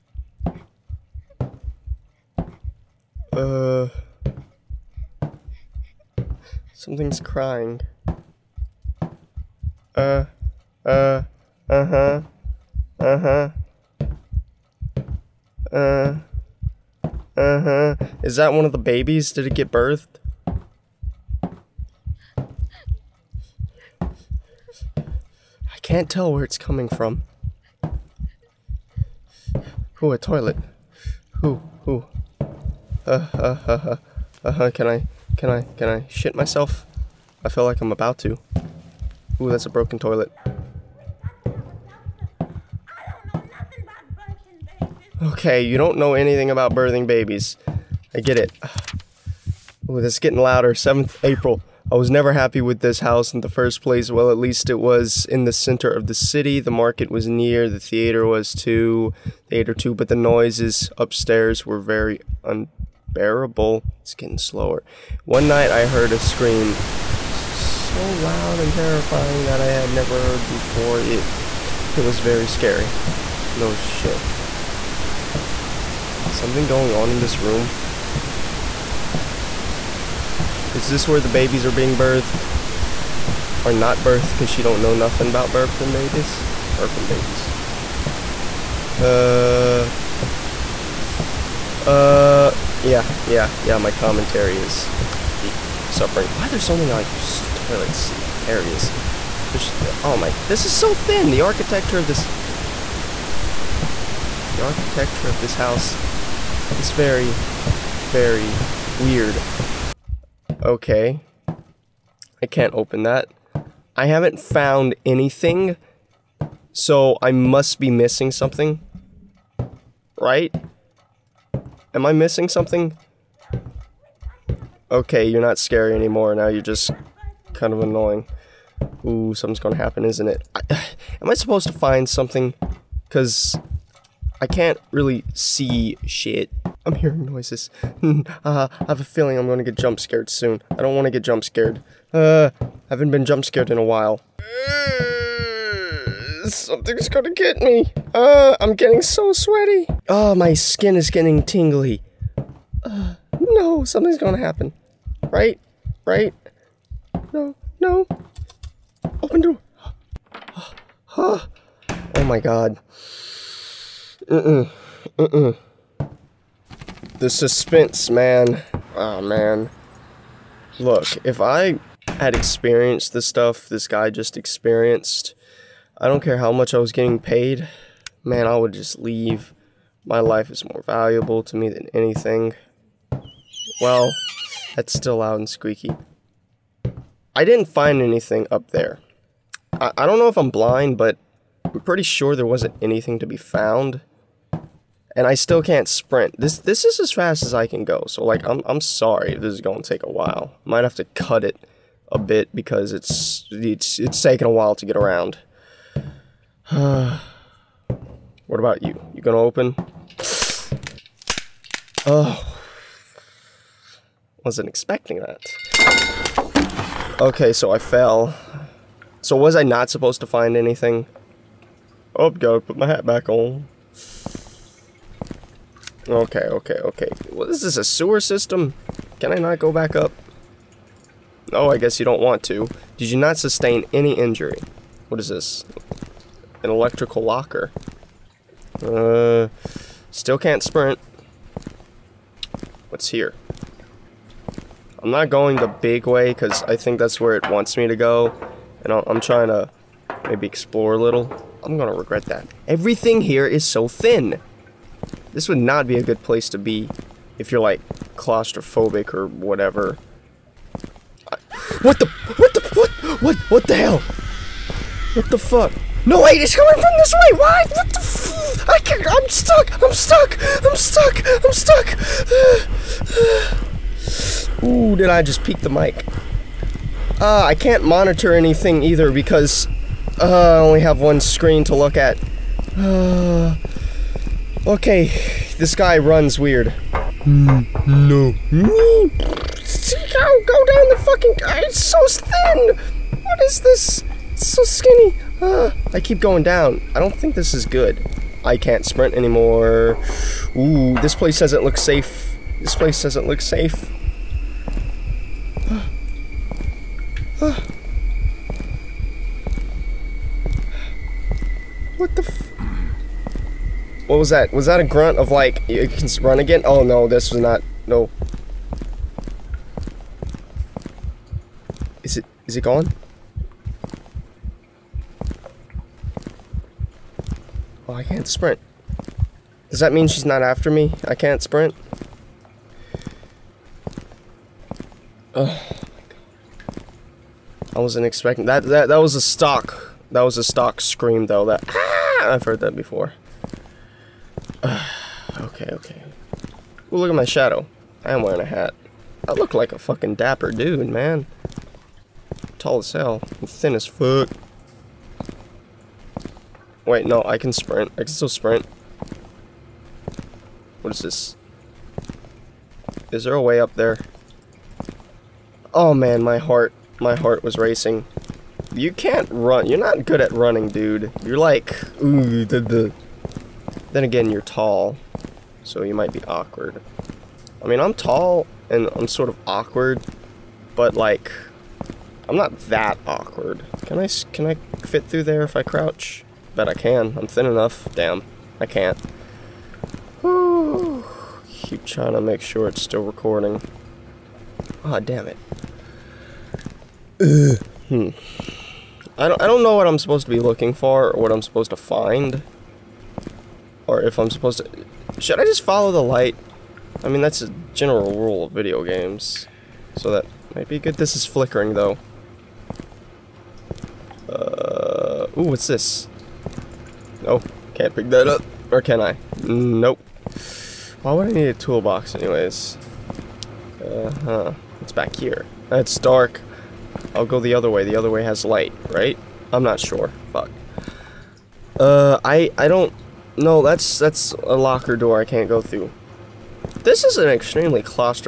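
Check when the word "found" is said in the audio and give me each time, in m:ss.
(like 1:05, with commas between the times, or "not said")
1:54, 3:13.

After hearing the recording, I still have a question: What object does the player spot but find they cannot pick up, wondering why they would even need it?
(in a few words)
A toolbox.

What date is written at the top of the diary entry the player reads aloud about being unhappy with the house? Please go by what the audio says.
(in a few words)
7th April.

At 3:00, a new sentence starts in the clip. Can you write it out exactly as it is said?
My life is more valuable to me than anything.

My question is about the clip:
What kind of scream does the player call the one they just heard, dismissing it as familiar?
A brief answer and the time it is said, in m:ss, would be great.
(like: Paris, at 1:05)
Stock scream, at 5:40.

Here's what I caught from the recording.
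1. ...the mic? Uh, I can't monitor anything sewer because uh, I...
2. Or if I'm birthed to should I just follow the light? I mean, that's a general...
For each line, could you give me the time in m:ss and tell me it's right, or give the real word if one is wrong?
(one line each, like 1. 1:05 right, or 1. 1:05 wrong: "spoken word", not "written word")
1. 4:35 wrong: "either", not "sewer"
2. 6:43 wrong: "supposed", not "birthed".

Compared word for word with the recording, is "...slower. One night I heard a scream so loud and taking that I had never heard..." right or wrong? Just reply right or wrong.
wrong.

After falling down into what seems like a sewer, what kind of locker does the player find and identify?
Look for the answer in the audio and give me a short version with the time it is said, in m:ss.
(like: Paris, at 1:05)
Electrical locker, at 3:56.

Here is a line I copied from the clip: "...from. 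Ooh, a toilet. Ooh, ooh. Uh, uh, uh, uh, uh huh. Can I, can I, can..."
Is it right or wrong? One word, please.
right.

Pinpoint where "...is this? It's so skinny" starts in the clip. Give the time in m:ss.
4:53.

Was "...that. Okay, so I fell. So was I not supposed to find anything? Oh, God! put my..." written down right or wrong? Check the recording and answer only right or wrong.
right.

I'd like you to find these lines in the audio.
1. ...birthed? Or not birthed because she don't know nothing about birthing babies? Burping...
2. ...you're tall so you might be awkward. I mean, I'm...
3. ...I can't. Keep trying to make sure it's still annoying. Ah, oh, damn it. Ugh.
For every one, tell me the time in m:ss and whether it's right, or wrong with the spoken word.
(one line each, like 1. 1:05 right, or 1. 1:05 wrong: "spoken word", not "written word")
1. 1:21 right
2. 6:14 right
3. 6:28 wrong: "recording", not "annoying".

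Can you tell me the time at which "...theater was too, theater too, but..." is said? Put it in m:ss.
0:57.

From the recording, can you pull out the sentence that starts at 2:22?
Uh, I haven't been jump scared in a while.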